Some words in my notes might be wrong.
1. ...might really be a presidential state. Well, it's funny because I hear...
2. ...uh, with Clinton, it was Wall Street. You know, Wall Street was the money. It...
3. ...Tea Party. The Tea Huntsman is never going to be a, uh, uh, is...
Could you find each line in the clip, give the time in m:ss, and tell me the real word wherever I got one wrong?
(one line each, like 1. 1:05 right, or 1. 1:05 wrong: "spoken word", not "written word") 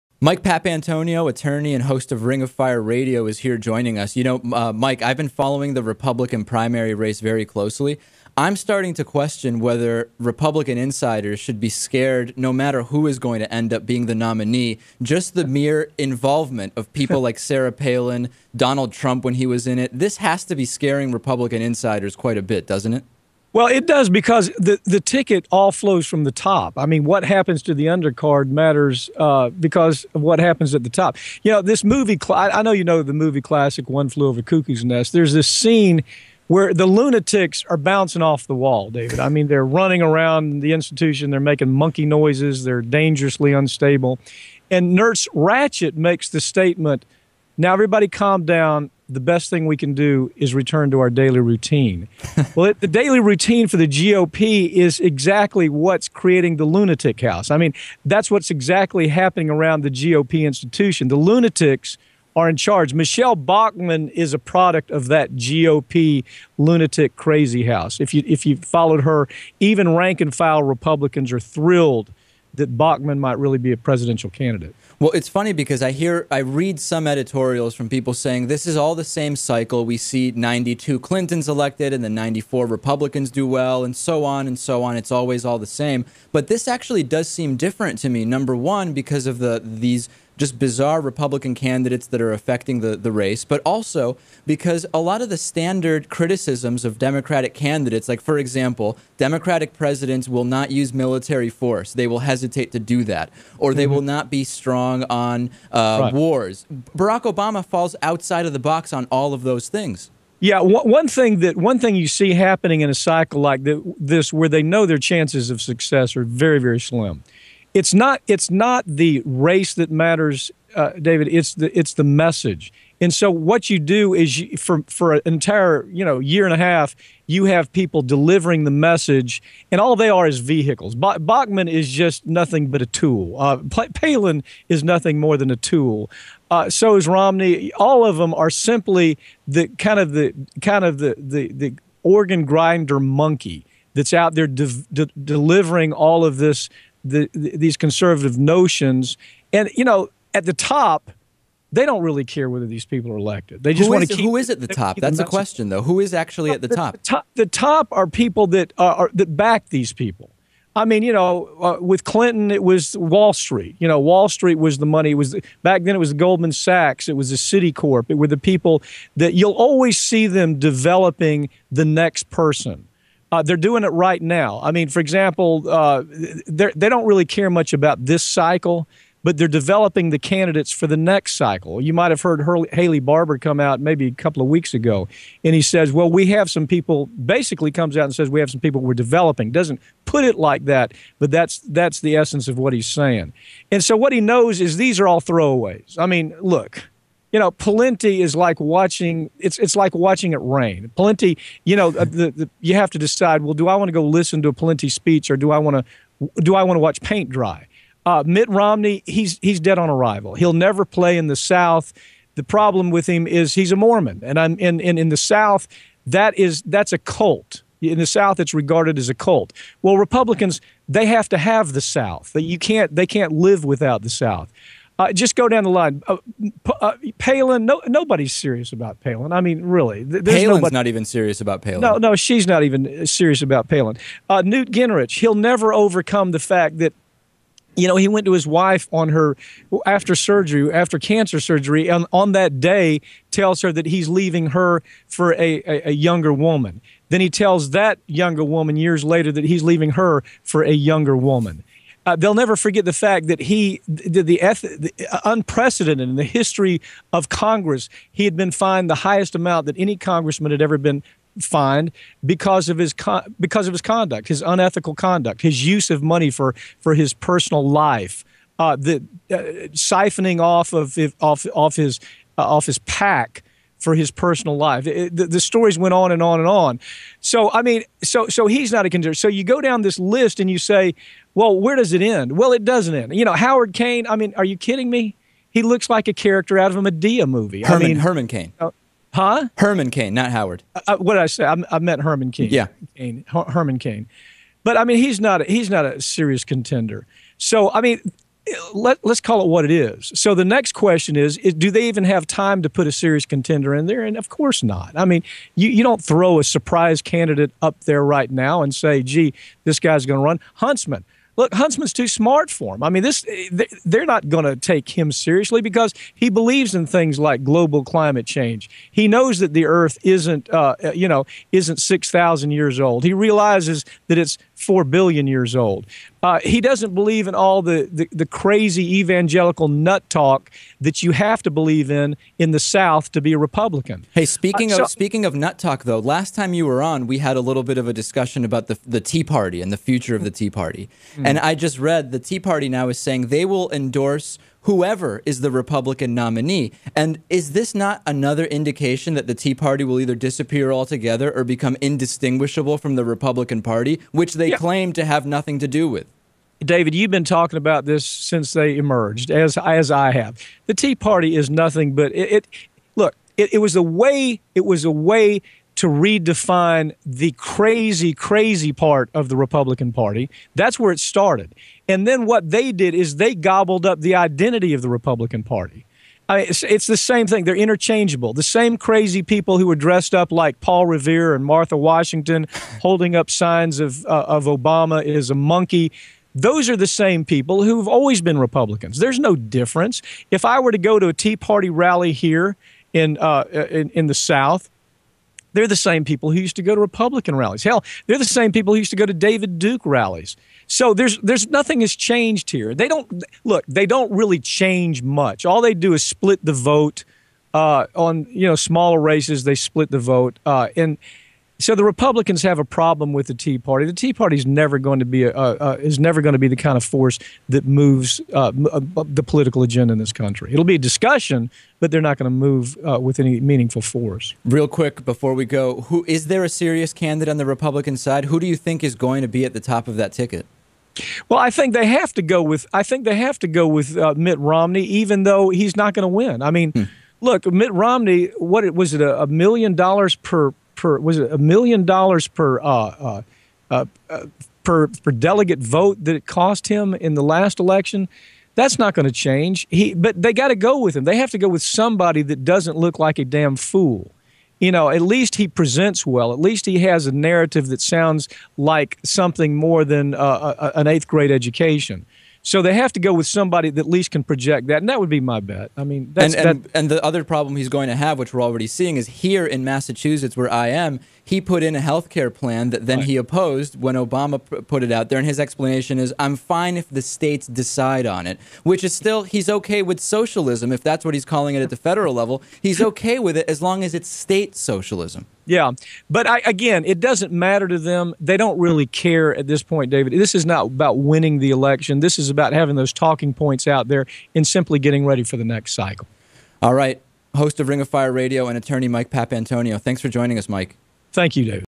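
1. 1:13 wrong: "candidate", not "state"
2. 2:41 right
3. 6:53 wrong: "Party", not "Huntsman".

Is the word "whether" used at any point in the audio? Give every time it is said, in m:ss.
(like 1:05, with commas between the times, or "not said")
0:09, 2:32.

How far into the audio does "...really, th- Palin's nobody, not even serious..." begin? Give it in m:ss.
3:49.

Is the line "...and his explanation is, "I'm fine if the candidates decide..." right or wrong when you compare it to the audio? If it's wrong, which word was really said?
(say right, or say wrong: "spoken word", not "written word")
wrong: "states", not "candidates".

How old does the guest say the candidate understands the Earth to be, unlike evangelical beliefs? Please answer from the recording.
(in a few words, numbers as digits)
4 billion years.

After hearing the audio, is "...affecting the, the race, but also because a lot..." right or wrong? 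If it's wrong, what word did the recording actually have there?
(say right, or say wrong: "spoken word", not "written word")
right.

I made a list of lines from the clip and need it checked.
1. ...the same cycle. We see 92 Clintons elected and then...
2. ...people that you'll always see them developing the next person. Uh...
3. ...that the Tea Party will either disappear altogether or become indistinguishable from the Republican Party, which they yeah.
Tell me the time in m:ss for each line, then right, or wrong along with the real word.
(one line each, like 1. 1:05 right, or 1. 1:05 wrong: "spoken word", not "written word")
1. 1:18 right
2. 2:48 right
3. 5:49 right.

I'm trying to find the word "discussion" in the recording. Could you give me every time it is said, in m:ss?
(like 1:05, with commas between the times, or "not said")
5:37, 7:00.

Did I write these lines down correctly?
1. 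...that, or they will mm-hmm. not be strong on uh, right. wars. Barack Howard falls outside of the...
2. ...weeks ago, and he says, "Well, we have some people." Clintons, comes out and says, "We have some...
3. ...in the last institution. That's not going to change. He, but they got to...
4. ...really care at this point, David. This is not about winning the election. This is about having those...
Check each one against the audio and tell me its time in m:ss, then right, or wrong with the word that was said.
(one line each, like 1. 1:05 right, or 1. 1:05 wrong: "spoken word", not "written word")
1. 1:43 wrong: "Obama", not "Howard"
2. 3:04 wrong: "Basically", not "Clintons"
3. 7:26 wrong: "election", not "institution"
4. 8:08 right.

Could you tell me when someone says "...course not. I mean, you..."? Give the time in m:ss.
5:04.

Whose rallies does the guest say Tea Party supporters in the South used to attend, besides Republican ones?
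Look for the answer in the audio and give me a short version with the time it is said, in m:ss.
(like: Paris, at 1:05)
David Duke, at 6:39.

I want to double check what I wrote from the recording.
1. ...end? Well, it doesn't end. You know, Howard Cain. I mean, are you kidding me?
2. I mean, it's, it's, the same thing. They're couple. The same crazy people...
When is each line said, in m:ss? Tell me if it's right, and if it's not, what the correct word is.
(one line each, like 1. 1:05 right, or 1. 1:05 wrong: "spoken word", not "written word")
1. 4:42 right
2. 6:16 wrong: "interchangeable", not "couple".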